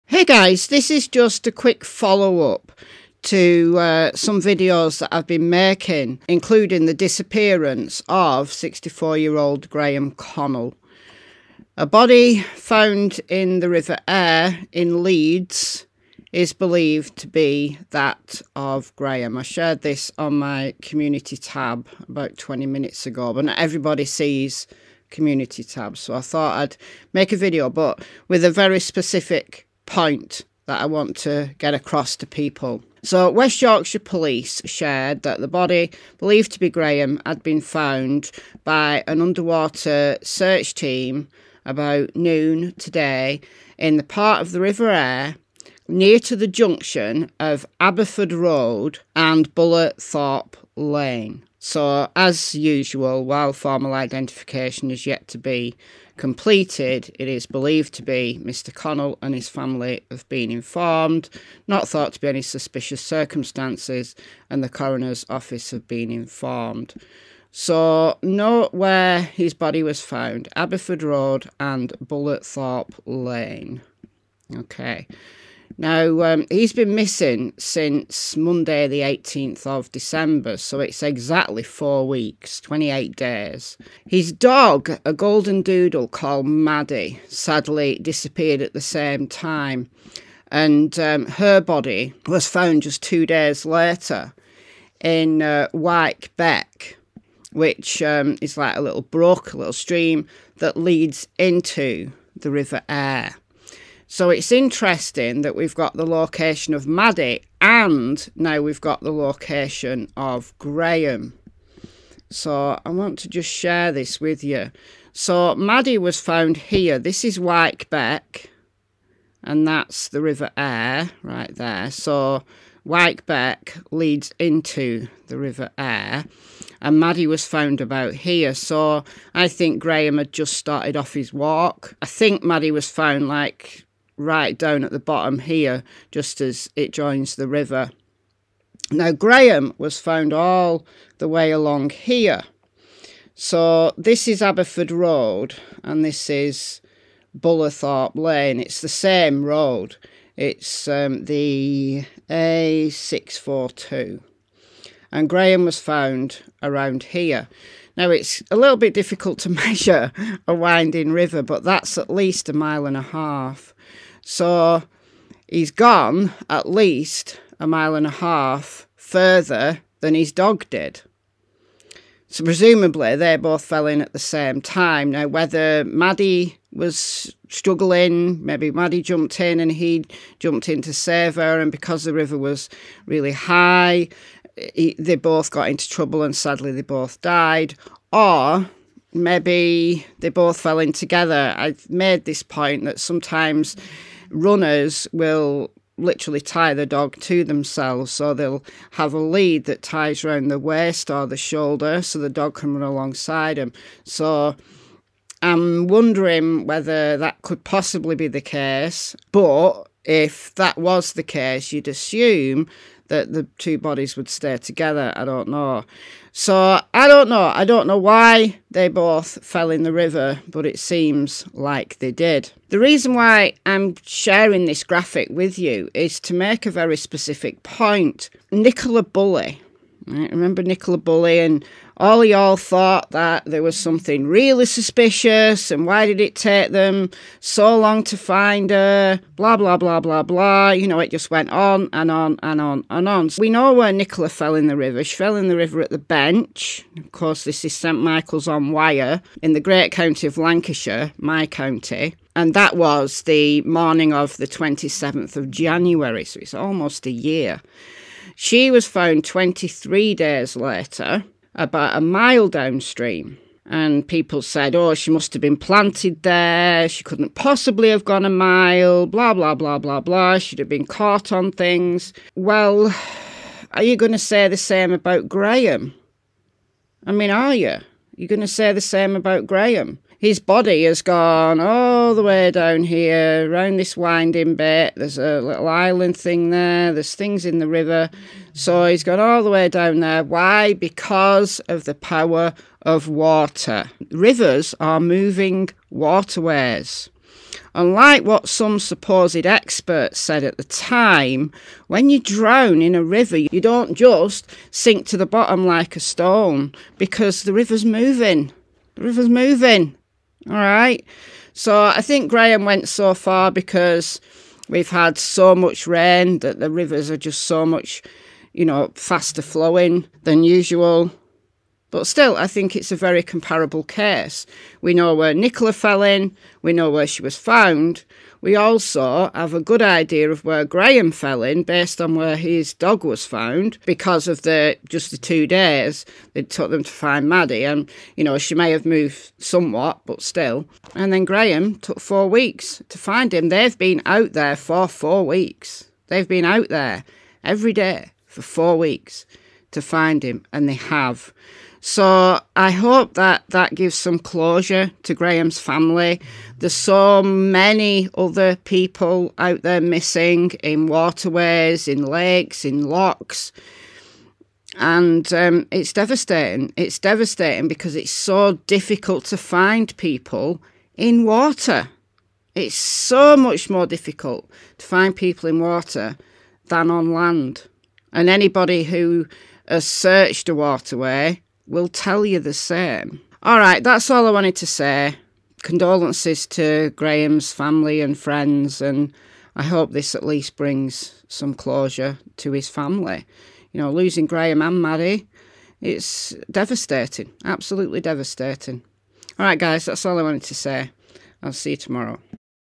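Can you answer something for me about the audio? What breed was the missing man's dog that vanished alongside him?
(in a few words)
Golden doodle.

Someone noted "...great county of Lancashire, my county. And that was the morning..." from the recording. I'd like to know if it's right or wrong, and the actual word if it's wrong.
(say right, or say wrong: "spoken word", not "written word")
right.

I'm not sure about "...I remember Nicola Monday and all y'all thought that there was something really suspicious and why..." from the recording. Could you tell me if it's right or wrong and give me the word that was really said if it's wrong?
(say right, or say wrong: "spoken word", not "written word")
wrong: "Bulley", not "Monday".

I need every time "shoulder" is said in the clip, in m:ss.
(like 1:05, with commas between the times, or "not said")
3:21.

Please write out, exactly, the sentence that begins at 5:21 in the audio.
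But still, I think it's a very comparable case.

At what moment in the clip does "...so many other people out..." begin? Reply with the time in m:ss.
5:56.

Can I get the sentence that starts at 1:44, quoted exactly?
So it's interesting that we've got the location of Maddie and now we've got the location of Graham.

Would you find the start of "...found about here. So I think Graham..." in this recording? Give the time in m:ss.
2:07.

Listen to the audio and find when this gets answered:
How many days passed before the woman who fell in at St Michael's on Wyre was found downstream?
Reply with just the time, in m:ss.
4:19.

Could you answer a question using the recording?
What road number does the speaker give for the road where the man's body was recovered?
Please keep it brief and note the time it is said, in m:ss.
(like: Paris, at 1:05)
A642, at 2:32.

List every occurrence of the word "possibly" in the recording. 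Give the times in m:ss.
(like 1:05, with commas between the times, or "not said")
3:27, 4:27.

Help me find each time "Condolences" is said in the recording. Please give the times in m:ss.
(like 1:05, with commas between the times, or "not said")
6:25.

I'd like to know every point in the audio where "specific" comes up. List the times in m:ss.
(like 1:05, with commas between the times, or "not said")
0:28, 3:46.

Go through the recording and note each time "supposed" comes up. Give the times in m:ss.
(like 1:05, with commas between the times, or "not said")
4:58.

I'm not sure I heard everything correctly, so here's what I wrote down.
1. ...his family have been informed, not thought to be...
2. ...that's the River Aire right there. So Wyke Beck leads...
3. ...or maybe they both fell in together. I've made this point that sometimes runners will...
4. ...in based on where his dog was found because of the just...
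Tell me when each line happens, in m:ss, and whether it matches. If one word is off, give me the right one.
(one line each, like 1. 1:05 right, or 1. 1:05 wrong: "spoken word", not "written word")
1. 0:59 right
2. 1:59 right
3. 3:08 right
4. 5:31 right.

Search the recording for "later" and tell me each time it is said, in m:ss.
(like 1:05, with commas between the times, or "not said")
1:33, 4:20.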